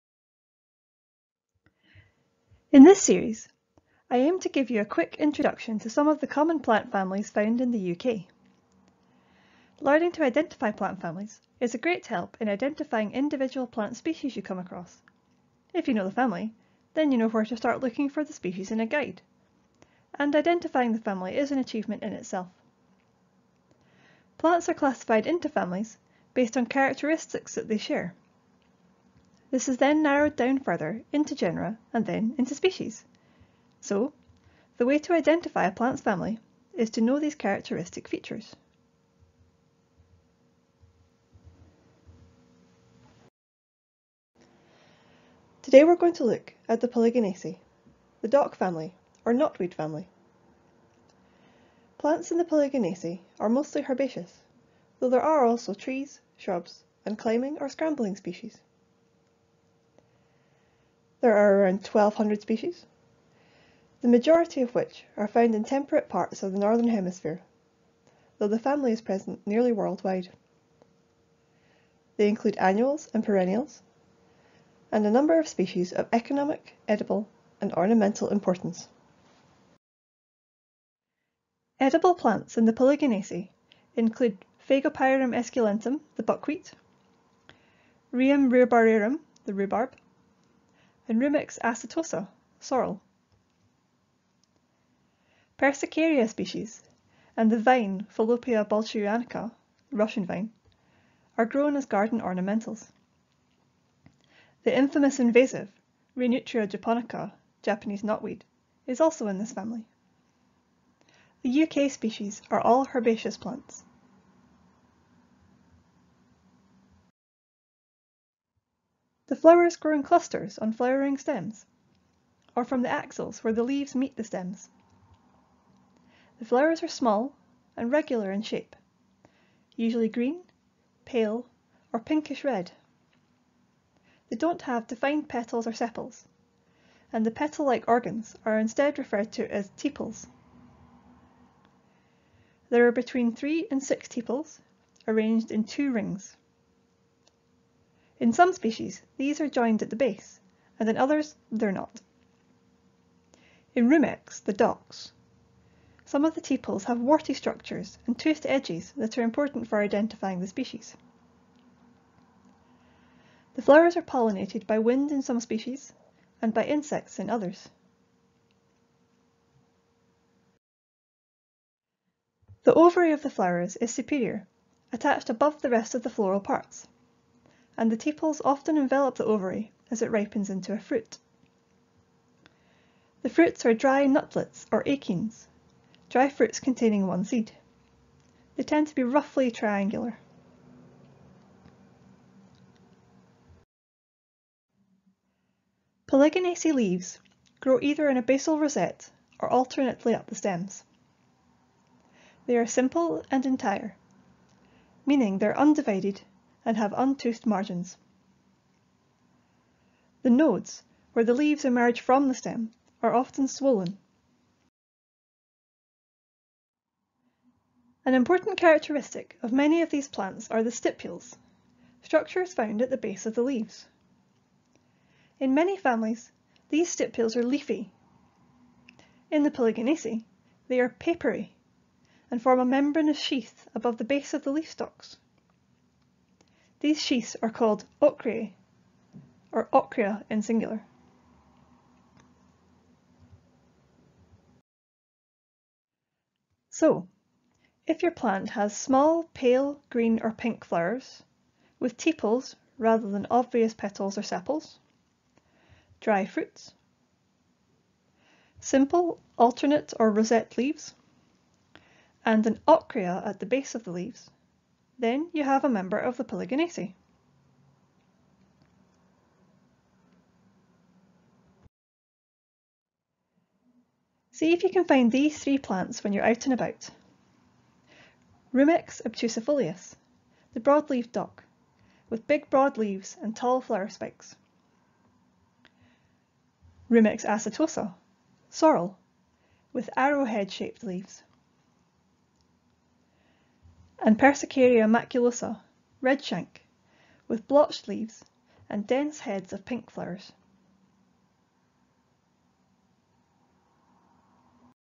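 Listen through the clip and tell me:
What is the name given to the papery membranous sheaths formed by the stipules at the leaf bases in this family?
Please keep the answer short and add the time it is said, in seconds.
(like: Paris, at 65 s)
ocreae, at 238 s.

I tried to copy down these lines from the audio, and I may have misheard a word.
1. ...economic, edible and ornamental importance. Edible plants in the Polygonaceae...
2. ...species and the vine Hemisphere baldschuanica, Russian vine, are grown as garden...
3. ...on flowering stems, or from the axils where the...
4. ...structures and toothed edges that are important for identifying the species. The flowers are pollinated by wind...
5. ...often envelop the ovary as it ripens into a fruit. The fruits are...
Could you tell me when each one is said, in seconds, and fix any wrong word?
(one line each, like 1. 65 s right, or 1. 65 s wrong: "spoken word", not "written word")
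1. 76 s right
2. 96 s wrong: "Fallopia", not "Hemisphere"
3. 120 s right
4. 157 s right
5. 178 s right.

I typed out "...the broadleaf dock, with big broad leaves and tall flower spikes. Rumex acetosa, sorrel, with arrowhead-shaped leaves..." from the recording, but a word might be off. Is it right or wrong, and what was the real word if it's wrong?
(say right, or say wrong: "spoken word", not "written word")
right.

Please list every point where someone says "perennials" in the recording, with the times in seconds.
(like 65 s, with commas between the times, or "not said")
73 s.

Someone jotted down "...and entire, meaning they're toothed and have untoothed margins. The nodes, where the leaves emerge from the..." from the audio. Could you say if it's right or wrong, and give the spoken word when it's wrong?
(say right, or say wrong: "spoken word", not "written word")
wrong: "undivided", not "toothed".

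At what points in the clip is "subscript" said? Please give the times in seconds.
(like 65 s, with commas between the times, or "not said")
not said.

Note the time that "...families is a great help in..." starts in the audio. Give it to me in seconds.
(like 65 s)
11 s.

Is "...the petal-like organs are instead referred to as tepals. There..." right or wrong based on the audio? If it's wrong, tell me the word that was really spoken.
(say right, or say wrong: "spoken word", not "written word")
right.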